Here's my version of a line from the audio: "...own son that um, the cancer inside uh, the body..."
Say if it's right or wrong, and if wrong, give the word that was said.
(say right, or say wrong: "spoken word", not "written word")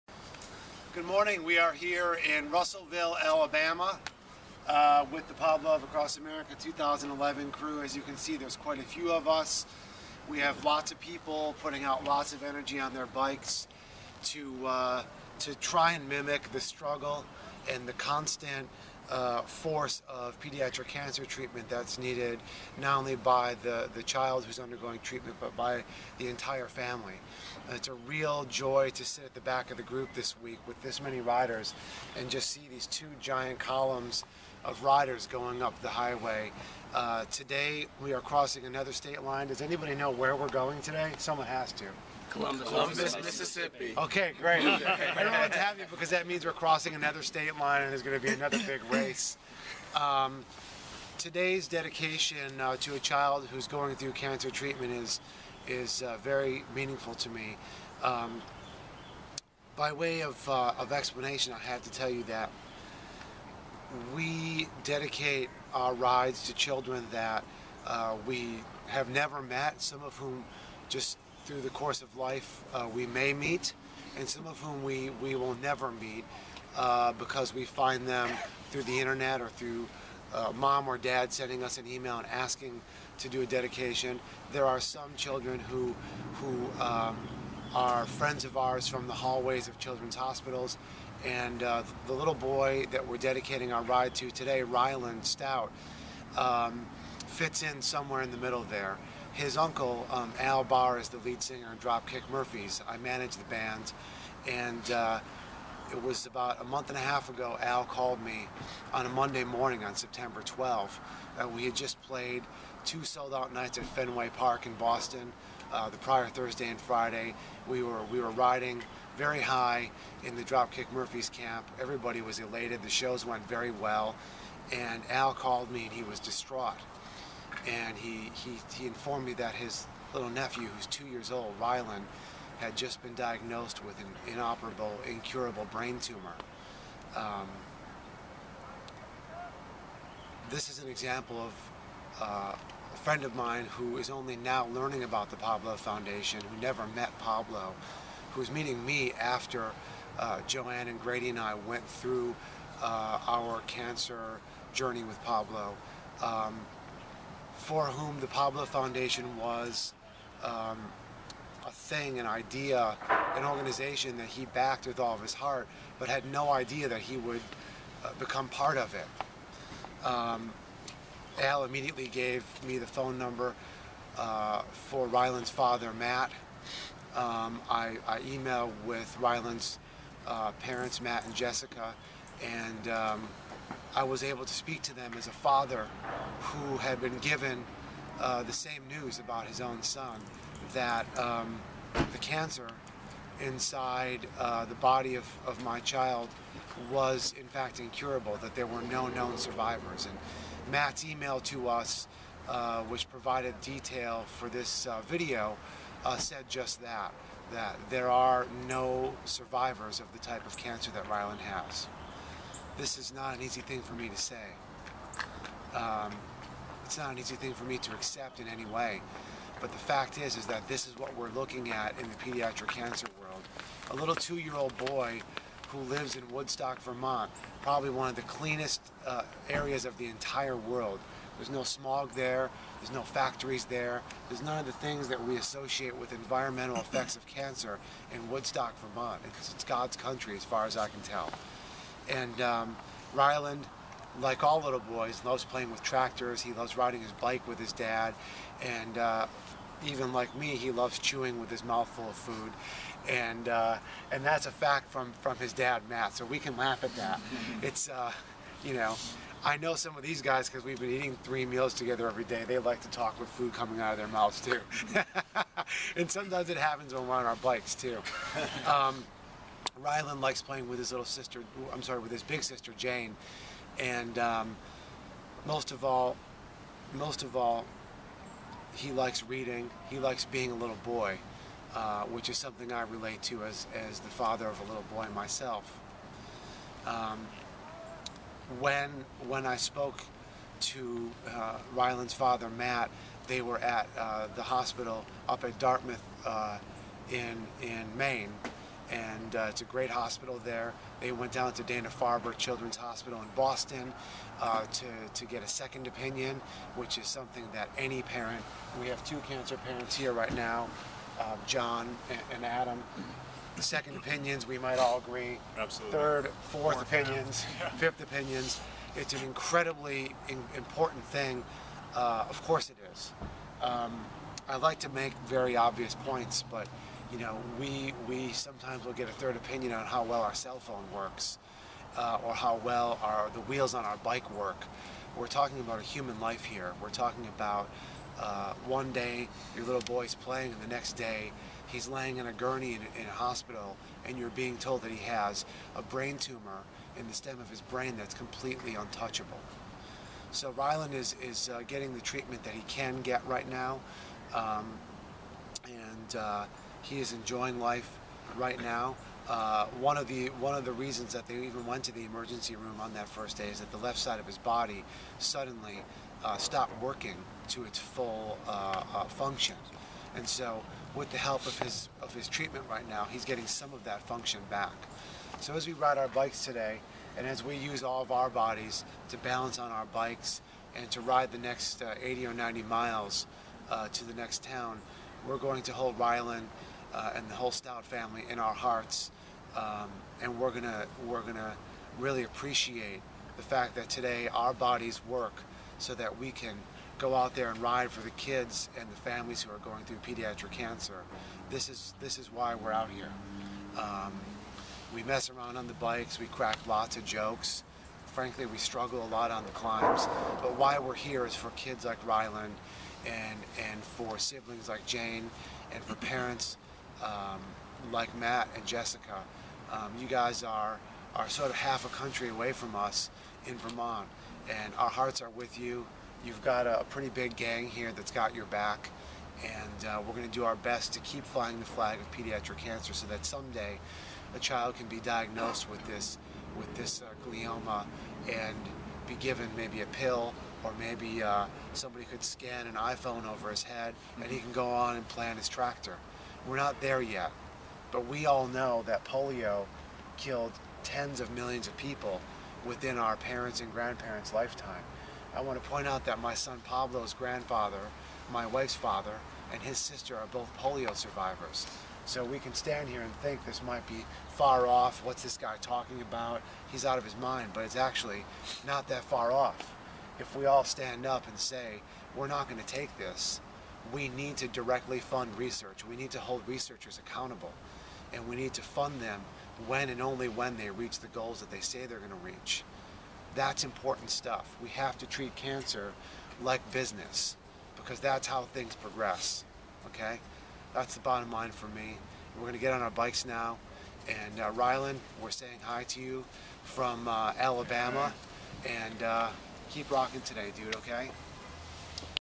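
right.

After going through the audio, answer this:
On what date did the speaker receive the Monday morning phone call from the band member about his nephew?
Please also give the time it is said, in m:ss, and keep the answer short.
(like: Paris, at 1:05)
September 12th, at 1:49.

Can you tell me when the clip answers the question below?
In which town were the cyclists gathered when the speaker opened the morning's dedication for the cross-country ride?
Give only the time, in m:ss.
0:02.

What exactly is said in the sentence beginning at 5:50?
So Ryland is, is uh, getting the treatment that he can get right now.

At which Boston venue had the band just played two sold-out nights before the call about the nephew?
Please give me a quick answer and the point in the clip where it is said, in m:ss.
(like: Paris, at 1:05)
Fenway Park, at 1:53.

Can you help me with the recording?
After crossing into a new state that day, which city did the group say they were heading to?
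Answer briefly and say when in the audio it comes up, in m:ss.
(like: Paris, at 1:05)
Columbus, Mississippi, at 0:42.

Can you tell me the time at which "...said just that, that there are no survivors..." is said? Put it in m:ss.
3:26.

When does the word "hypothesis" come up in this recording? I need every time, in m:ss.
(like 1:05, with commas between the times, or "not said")
not said.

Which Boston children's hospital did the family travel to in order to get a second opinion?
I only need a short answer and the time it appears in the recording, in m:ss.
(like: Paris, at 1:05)
Dana-Farber, at 5:01.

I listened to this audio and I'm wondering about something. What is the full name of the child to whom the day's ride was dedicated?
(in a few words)
Ryland Stout.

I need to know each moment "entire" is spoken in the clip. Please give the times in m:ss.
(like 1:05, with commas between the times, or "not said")
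0:26, 3:50.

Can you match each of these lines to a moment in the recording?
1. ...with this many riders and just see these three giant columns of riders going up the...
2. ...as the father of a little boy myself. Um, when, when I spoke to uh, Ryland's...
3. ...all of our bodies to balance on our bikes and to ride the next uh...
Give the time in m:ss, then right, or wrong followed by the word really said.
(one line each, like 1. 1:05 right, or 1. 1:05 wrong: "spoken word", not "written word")
1. 0:30 wrong: "two", not "three"
2. 4:43 right
3. 6:17 right.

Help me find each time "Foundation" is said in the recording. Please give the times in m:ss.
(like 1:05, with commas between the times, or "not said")
2:25, 2:38.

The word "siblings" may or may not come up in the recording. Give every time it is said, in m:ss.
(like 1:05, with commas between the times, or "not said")
6:54.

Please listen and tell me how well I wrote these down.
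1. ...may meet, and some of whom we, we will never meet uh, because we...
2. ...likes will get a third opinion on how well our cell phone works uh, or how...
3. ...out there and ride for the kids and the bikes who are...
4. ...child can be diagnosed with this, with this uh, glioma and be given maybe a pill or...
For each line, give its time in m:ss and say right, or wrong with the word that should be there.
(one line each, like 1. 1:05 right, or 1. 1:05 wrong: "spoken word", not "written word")
1. 1:13 right
2. 5:28 wrong: "sometimes", not "likes"
3. 6:37 wrong: "families", not "bikes"
4. 7:14 right.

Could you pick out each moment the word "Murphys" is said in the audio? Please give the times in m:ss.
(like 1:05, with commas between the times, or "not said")
1:42, 2:00.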